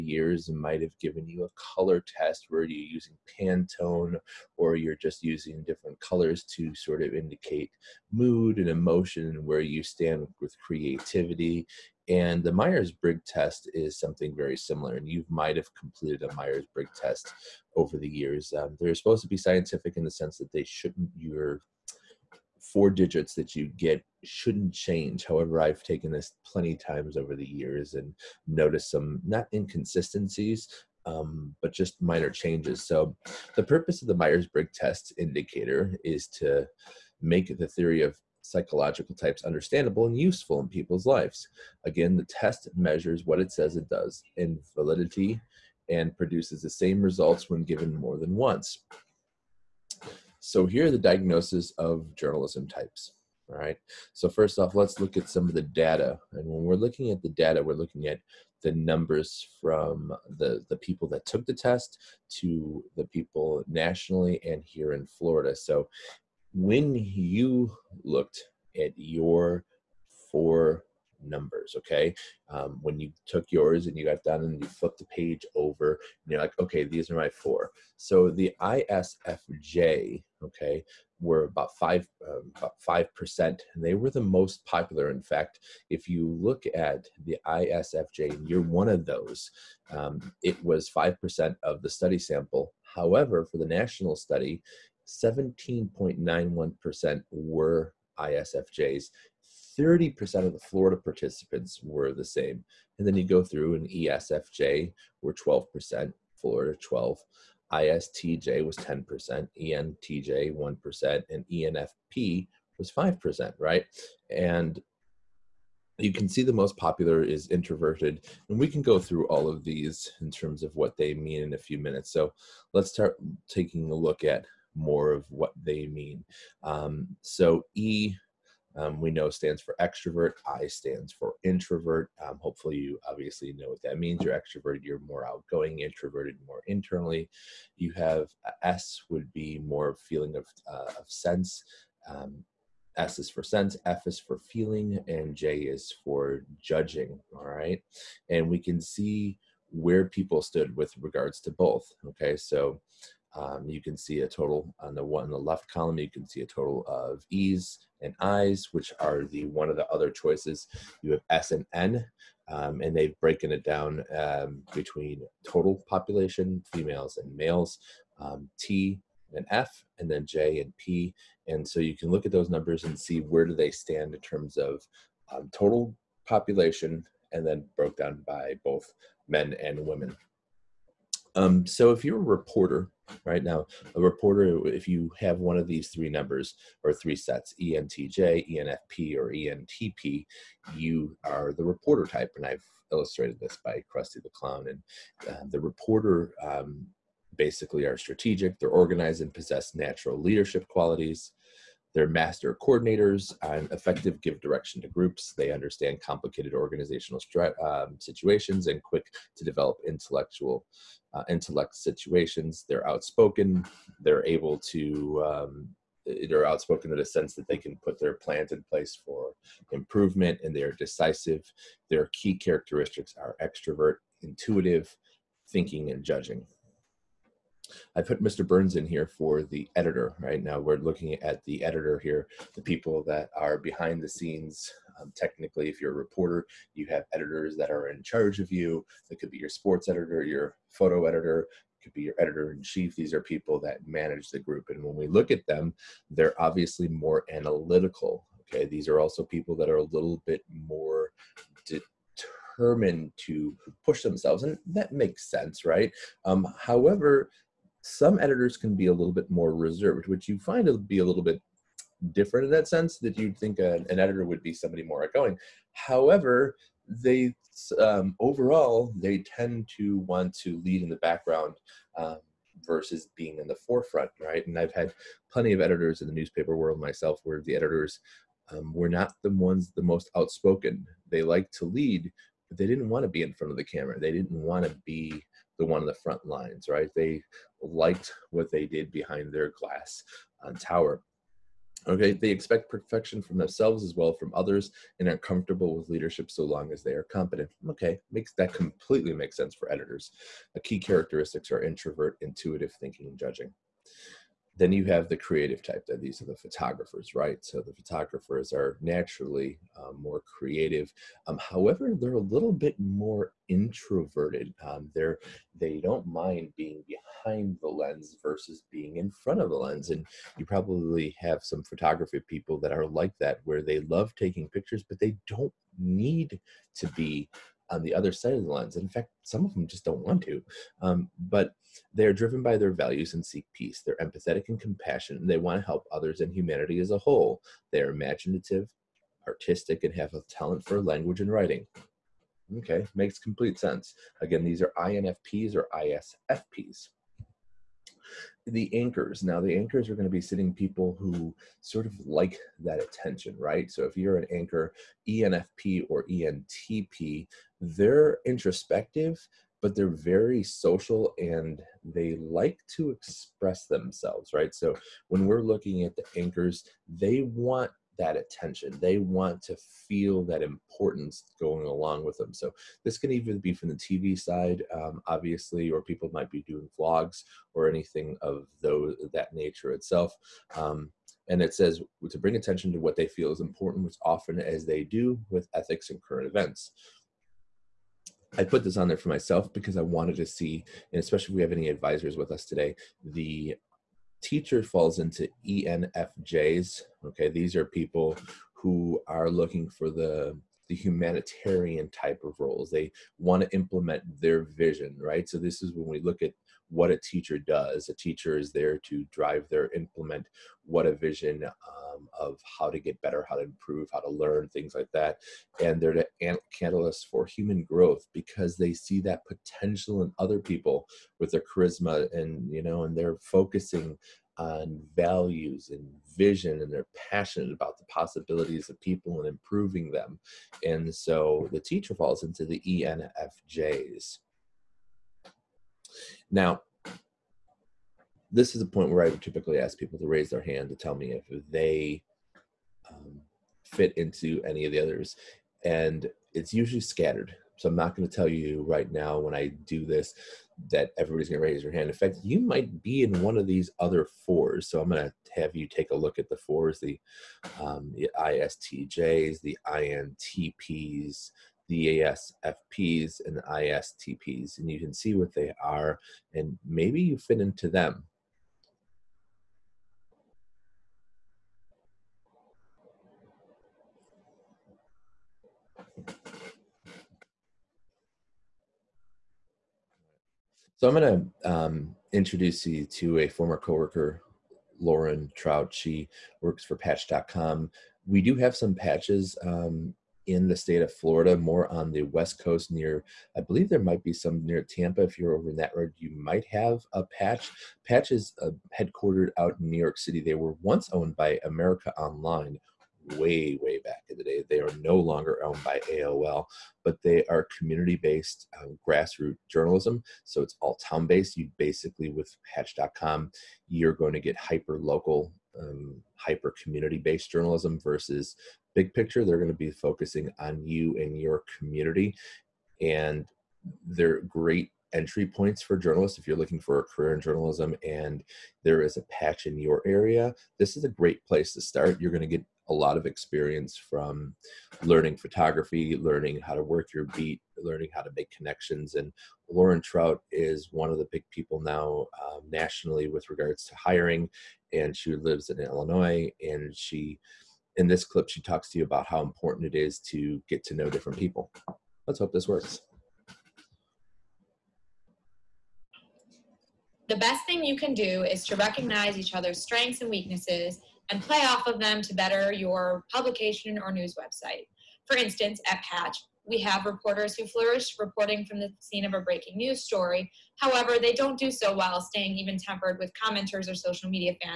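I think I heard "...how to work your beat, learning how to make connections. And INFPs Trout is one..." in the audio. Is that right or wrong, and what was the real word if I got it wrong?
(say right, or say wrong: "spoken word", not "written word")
wrong: "Lauren", not "INFPs".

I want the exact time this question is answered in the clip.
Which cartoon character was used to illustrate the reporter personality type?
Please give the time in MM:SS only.
03:13.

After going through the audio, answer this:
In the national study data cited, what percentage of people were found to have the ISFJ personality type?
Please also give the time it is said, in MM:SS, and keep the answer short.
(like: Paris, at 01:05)
17.91%, at 01:35.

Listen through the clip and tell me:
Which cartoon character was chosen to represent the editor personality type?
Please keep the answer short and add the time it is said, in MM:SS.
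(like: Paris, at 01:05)
Mr. Burns, at 03:48.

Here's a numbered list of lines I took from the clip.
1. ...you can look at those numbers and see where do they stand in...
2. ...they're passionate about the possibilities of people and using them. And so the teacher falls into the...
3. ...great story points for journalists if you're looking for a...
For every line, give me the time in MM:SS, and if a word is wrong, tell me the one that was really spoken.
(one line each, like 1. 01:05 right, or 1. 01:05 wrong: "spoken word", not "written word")
1. 02:51 right
2. 07:06 wrong: "improving", not "using"
3. 08:44 wrong: "entry", not "story".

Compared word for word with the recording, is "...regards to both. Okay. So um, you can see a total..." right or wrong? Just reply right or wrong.
right.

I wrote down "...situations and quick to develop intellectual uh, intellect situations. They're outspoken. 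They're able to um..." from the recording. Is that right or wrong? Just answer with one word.
right.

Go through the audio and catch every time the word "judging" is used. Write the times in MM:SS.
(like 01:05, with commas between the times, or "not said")
02:26, 03:46, 05:03.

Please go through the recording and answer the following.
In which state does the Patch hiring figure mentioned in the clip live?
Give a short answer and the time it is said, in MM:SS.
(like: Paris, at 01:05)
Illinois, at 09:05.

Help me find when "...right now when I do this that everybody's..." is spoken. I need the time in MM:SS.
07:28.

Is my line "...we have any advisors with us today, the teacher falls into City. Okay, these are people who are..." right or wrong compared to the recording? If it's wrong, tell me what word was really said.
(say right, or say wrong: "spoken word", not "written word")
wrong: "ENFJs", not "City".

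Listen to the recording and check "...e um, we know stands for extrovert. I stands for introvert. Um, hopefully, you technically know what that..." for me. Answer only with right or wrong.
wrong.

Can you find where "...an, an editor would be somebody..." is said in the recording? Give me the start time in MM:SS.
04:23.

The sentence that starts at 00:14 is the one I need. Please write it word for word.
And you might have completed a Myers Briggs test over the years.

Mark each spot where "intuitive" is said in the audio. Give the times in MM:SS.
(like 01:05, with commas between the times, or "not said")
03:44, 05:02.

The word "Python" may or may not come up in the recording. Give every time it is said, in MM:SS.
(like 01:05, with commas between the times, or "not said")
not said.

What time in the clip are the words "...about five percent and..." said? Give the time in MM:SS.
01:22.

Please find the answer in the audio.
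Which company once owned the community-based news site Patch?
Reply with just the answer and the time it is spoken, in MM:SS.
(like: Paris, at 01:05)
America Online, at 08:21.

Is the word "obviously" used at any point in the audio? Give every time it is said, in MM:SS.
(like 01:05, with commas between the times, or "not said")
02:13, 04:06, 06:15.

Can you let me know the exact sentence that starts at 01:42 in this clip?
And then you go through and ESFJ were 12%, Florida 12, ISTJ was 10%, ENTJ 1%, and ENFP was 5%, right?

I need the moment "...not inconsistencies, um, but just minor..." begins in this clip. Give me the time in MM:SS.
00:29.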